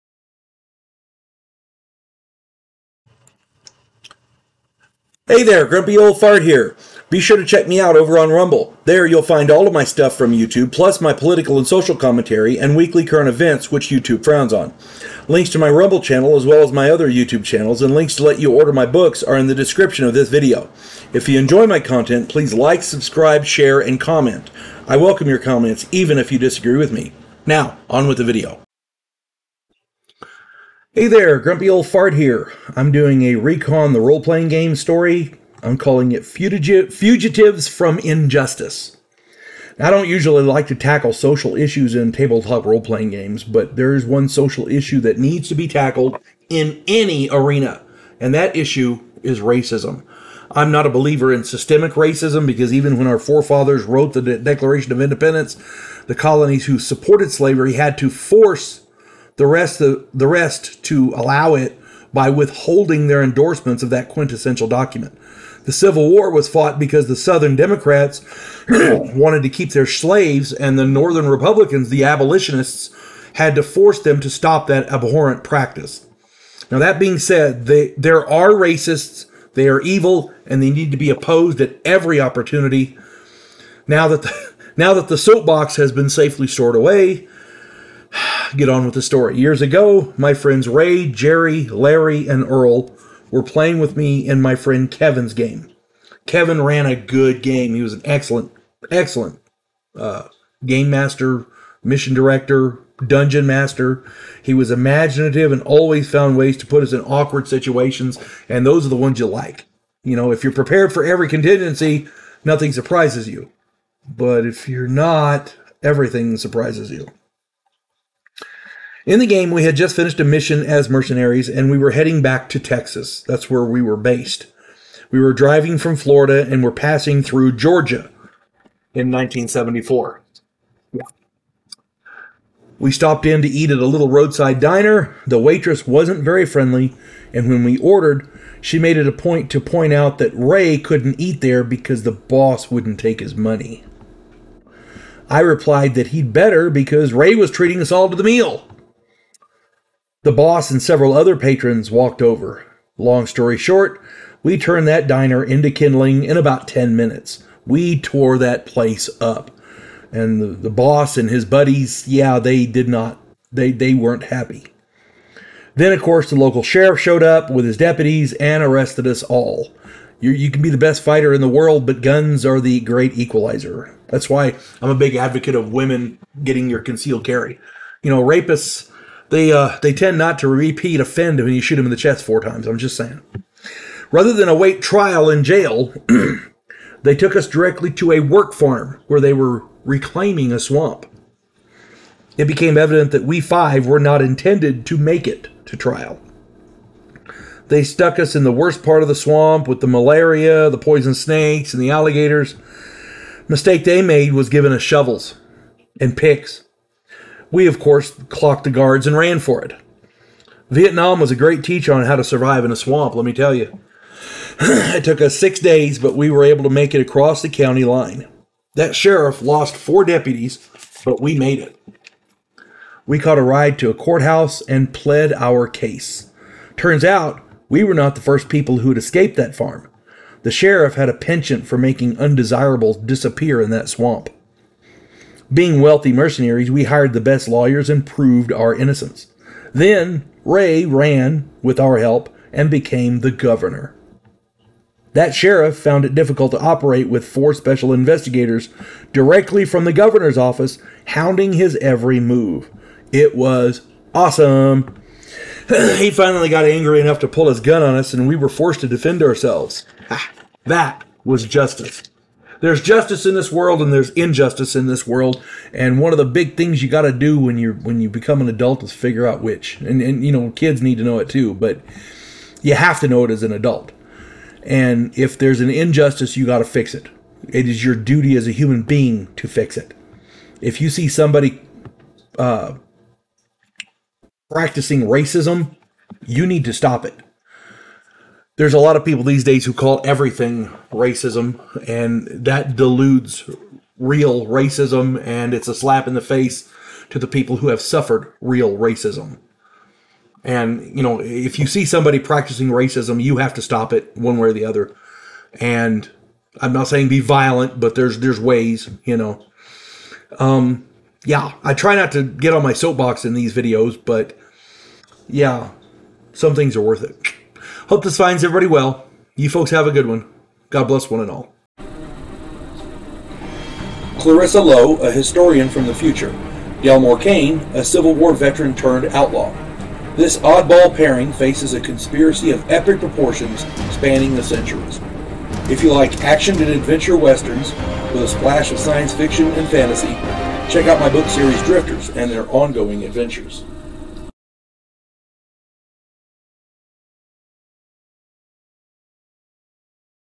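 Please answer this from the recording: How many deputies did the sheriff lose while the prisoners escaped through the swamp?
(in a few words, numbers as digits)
4.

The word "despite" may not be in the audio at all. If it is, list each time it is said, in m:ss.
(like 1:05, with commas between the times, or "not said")
not said.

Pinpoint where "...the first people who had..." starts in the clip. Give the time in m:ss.
3:48.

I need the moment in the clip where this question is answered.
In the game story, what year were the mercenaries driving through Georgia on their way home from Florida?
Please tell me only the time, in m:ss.
2:09.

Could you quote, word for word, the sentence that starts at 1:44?
He was imaginative and always found ways to put us in awkward situations, and those are the ones you like.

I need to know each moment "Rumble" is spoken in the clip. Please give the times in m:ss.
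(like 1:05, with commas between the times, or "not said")
0:08, 0:15.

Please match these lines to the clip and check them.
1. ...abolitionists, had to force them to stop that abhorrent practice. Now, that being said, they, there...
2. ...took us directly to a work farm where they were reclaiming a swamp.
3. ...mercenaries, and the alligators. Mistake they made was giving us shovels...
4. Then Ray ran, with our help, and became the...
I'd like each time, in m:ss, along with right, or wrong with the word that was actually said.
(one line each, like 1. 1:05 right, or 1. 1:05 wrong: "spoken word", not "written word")
1. 1:12 right
2. 3:07 right
3. 3:21 wrong: "snakes", not "mercenaries"
4. 3:59 right.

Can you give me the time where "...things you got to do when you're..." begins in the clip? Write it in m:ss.
4:26.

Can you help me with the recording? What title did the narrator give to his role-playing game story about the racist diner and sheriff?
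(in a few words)
Fugitives from Injustice.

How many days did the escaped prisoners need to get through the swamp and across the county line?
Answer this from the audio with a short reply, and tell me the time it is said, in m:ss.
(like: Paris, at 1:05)
6, at 3:35.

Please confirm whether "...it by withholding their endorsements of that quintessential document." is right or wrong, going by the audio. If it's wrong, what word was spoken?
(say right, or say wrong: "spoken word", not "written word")
right.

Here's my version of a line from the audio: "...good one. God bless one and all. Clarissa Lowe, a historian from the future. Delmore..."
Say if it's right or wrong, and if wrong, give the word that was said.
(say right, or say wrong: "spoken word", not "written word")
right.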